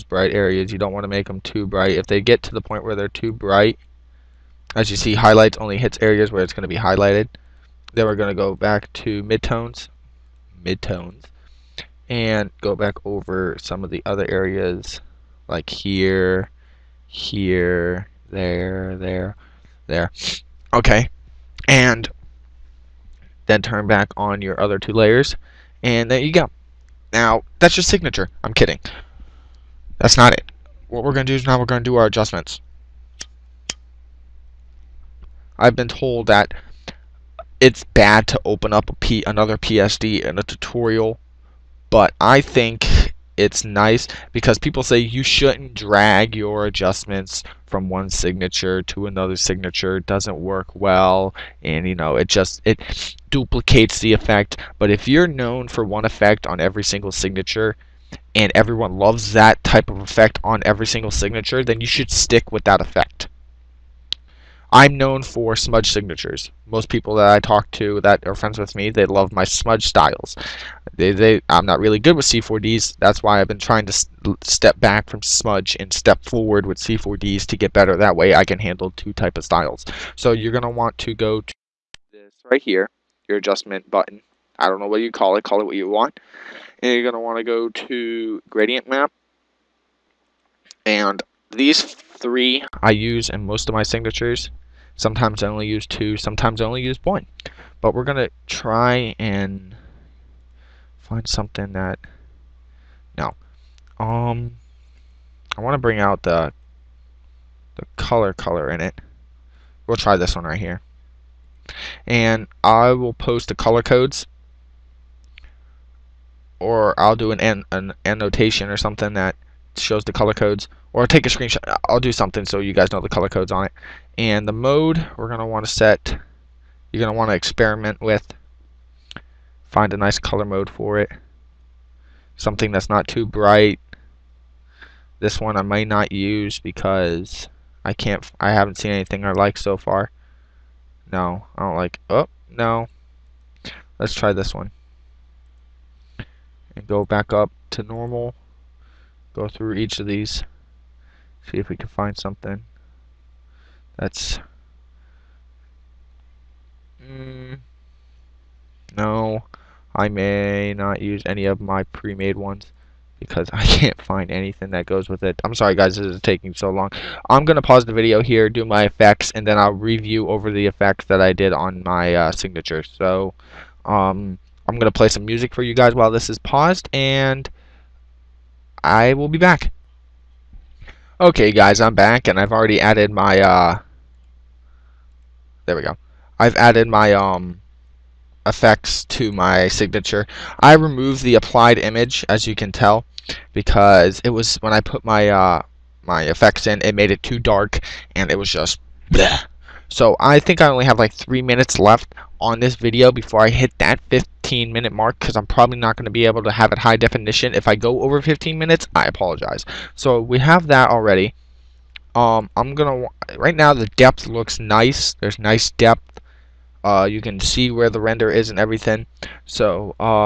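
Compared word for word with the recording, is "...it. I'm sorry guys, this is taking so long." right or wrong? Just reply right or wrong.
right.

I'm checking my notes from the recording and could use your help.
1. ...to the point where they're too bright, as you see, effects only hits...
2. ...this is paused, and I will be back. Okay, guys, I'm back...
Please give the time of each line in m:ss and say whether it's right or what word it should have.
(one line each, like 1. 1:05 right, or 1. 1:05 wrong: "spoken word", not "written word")
1. 0:02 wrong: "highlights", not "effects"
2. 2:56 right.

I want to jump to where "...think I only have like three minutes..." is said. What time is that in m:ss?
3:20.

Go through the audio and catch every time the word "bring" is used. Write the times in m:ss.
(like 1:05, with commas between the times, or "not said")
1:45.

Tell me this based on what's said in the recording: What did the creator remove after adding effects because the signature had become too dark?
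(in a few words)
The applied image.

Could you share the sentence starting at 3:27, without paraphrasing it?
If I go over 15 minutes, I apologize.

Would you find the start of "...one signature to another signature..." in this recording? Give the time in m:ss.
0:47.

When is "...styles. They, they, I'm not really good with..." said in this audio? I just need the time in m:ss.
1:09.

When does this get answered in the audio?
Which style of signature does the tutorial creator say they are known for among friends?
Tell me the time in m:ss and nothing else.
1:05.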